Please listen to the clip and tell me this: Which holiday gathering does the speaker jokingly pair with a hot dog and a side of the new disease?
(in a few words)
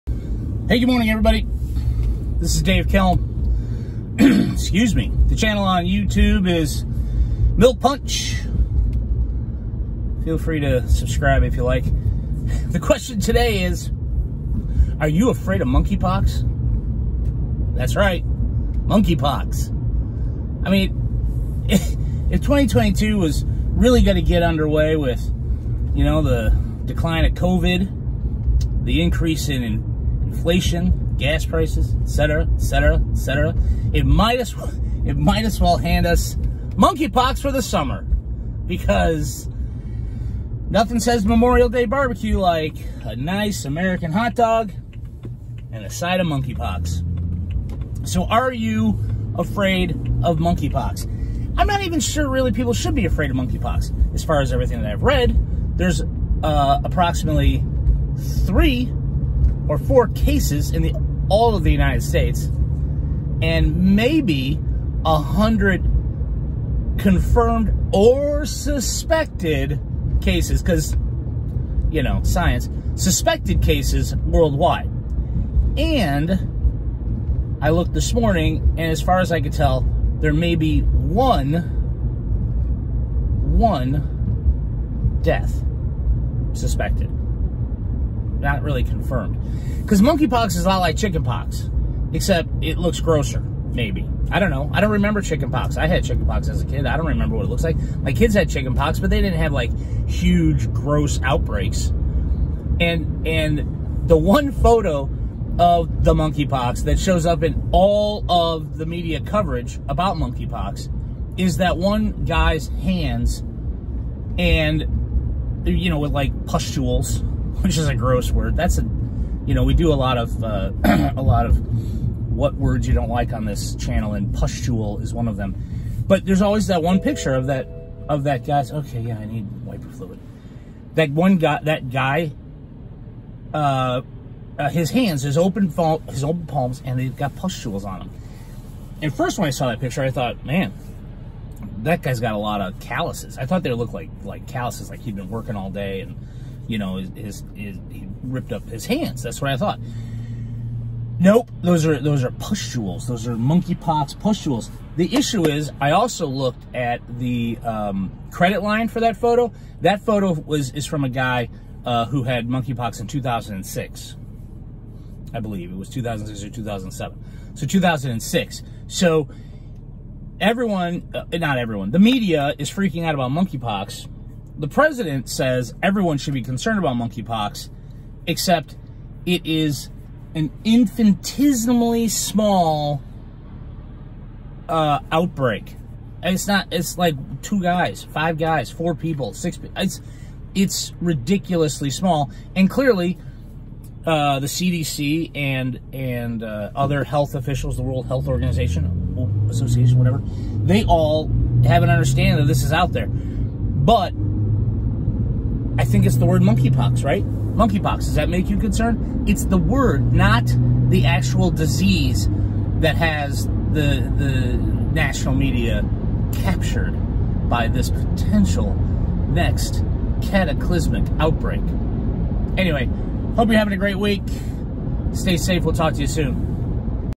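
Memorial Day barbecue.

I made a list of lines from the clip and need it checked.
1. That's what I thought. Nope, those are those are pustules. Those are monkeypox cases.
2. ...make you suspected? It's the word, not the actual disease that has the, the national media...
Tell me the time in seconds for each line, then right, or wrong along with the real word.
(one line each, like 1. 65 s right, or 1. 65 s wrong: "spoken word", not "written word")
1. 149 s wrong: "pustules", not "cases"
2. 208 s wrong: "concerned", not "suspected".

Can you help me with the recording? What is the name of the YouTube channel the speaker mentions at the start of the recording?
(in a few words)
Milk Punch.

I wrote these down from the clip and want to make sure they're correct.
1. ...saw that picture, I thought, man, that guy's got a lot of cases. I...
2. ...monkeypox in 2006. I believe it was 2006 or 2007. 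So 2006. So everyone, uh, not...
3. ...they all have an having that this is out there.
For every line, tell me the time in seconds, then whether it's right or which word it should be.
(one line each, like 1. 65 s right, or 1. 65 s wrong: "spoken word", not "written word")
1. 139 s wrong: "calluses", not "cases"
2. 162 s right
3. 200 s wrong: "understanding", not "having".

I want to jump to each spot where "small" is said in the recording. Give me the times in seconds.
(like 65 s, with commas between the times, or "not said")
182 s, 191 s.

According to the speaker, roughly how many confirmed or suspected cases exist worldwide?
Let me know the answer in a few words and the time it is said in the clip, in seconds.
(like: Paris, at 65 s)
100, at 65 s.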